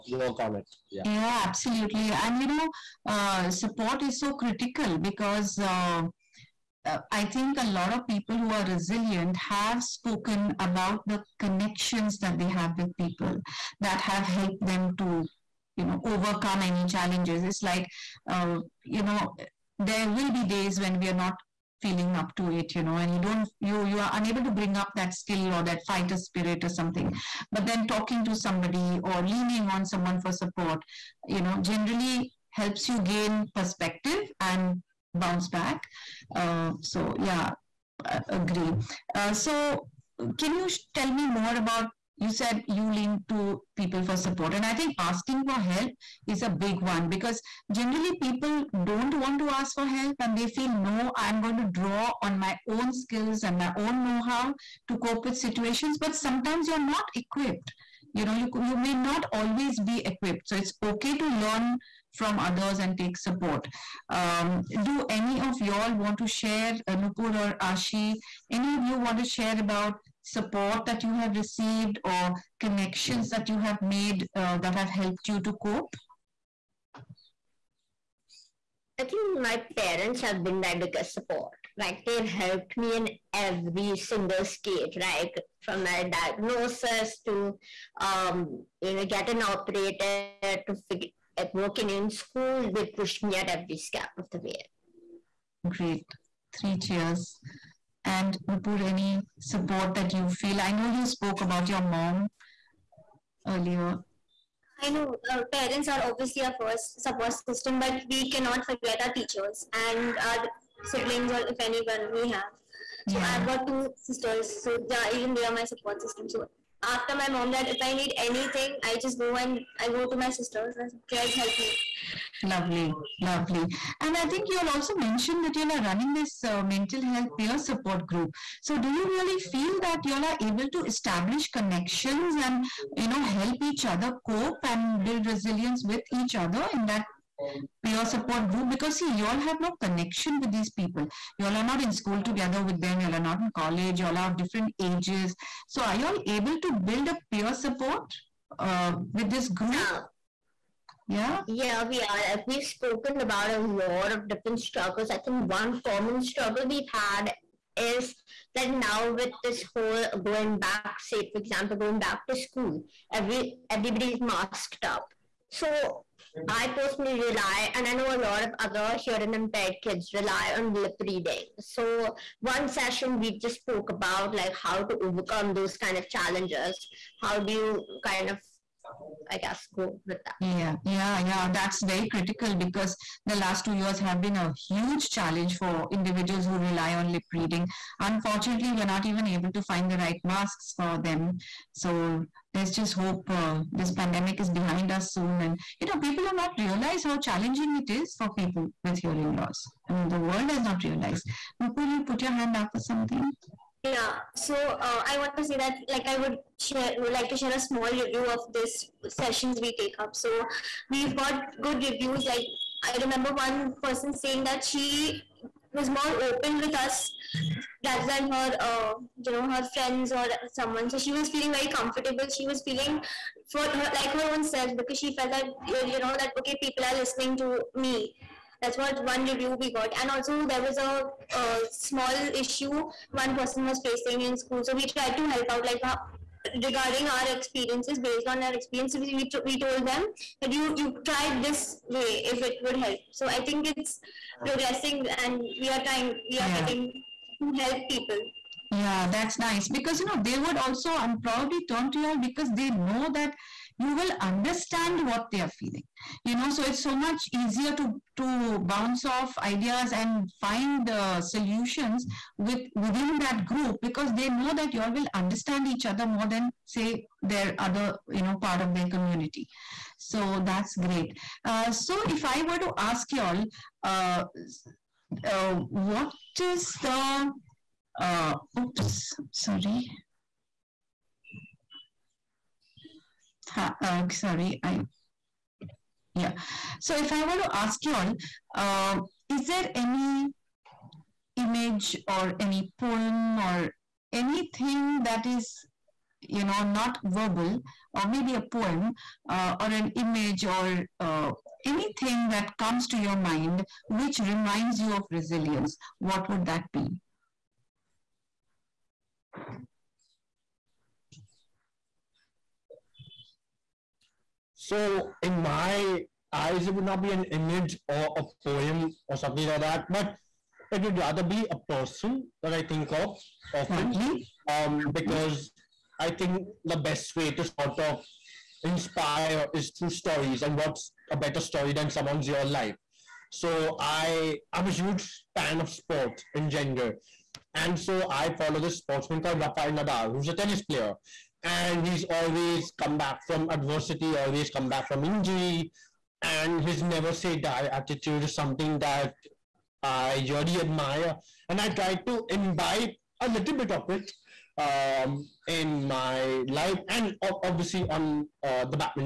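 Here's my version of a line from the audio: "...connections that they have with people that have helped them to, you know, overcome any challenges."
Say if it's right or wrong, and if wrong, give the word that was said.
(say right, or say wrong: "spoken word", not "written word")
right.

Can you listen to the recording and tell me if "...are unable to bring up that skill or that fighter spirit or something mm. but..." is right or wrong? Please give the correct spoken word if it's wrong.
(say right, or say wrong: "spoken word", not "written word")
right.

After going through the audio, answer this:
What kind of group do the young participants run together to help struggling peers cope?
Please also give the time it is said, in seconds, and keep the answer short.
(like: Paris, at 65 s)
mental health peer support group, at 126 s.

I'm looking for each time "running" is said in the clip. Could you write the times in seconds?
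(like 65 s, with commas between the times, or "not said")
125 s.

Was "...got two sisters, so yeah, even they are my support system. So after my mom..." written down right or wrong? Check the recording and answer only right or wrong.
right.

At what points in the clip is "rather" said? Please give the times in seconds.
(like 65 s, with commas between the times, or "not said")
217 s, 320 s.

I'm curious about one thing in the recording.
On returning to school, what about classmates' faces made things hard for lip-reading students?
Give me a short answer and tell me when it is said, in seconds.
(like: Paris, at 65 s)
masked up, at 164 s.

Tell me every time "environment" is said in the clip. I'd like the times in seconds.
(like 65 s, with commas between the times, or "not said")
not said.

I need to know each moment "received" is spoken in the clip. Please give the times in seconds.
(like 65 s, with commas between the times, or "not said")
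71 s.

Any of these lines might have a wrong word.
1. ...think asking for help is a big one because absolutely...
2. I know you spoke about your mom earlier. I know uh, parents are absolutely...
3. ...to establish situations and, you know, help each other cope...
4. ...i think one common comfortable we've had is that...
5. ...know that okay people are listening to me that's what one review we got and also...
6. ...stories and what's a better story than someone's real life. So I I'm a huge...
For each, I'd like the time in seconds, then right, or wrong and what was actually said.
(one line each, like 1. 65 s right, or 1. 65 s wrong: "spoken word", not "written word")
1. 44 s wrong: "generally", not "absolutely"
2. 100 s wrong: "obviously", not "absolutely"
3. 130 s wrong: "connections", not "situations"
4. 155 s wrong: "struggle", not "comfortable"
5. 225 s right
6. 329 s right.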